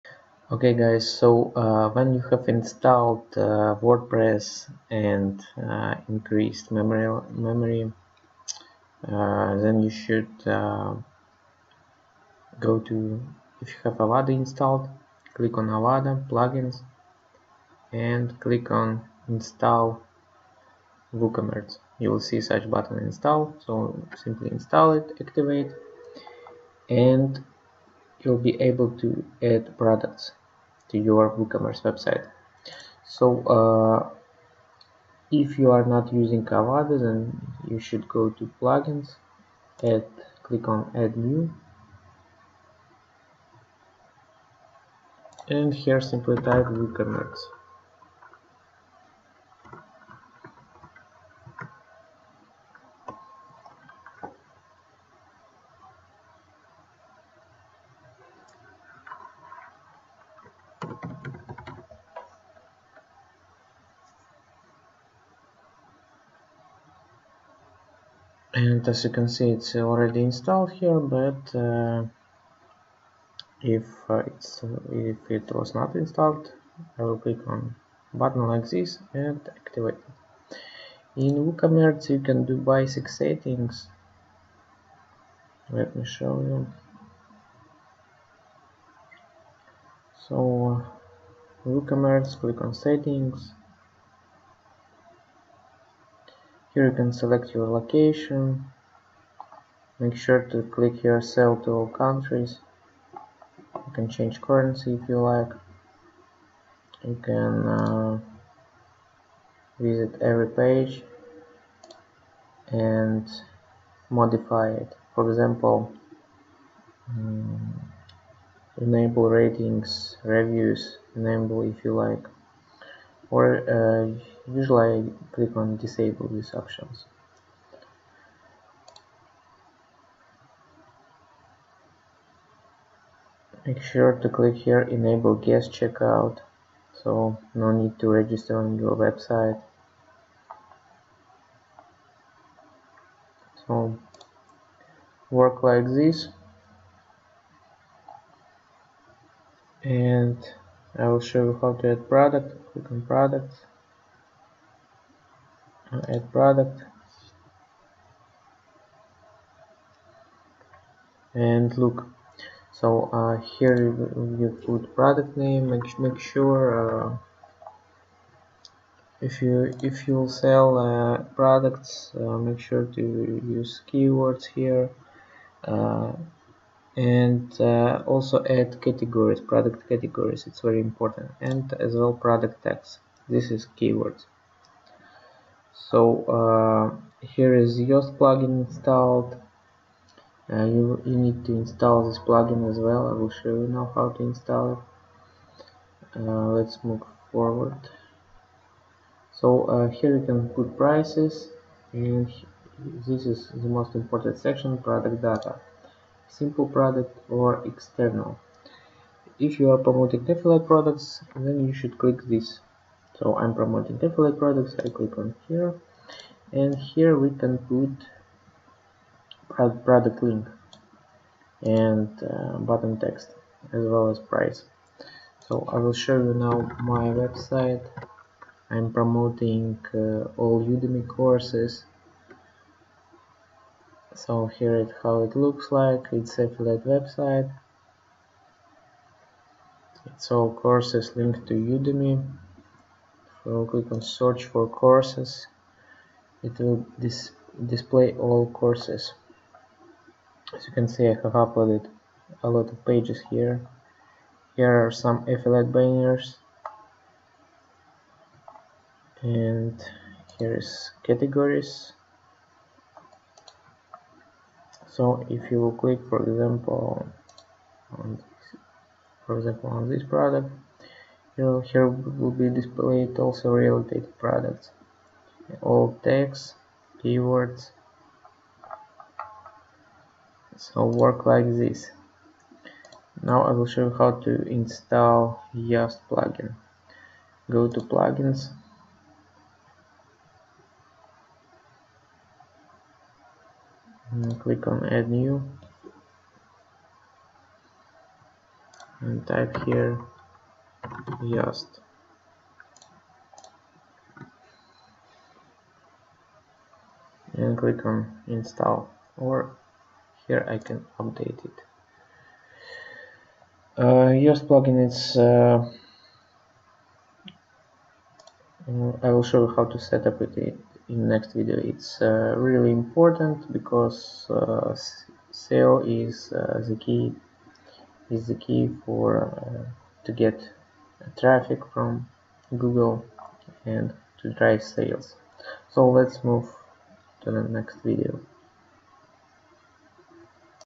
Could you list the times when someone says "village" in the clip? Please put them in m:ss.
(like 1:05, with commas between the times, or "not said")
not said.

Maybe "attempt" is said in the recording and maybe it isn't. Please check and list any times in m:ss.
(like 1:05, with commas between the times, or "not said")
not said.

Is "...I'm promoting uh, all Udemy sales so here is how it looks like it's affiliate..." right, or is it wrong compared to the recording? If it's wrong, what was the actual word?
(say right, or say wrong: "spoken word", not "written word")
wrong: "courses", not "sales".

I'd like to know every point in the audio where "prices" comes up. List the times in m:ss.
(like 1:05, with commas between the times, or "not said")
3:20, 3:44.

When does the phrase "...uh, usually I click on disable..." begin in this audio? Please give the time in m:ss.
2:03.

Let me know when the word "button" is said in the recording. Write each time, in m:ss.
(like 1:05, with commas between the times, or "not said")
0:22, 1:18, 3:42.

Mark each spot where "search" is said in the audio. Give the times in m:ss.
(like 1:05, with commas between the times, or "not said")
4:04.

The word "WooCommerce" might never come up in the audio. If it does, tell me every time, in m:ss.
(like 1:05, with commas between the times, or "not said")
0:21, 0:31, 0:46, 1:21, 1:31.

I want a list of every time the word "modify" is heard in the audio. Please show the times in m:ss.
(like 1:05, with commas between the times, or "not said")
1:54.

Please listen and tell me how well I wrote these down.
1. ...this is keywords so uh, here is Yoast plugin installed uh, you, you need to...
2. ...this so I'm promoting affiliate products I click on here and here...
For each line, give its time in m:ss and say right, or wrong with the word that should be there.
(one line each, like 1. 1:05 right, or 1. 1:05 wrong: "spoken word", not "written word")
1. 3:03 right
2. 3:32 right.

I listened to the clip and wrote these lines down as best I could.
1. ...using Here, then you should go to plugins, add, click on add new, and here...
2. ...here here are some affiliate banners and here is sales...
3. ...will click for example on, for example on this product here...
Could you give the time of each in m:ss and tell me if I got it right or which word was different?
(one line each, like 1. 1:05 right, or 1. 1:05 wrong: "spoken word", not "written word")
1. 0:36 wrong: "Avada", not "Here"
2. 4:13 wrong: "categories", not "sales"
3. 4:25 right.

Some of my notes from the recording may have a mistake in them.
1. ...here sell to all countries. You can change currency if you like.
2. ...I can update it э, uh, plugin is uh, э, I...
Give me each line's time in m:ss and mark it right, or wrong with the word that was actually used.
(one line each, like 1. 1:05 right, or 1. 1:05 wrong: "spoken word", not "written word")
1. 1:41 right
2. 5:10 right.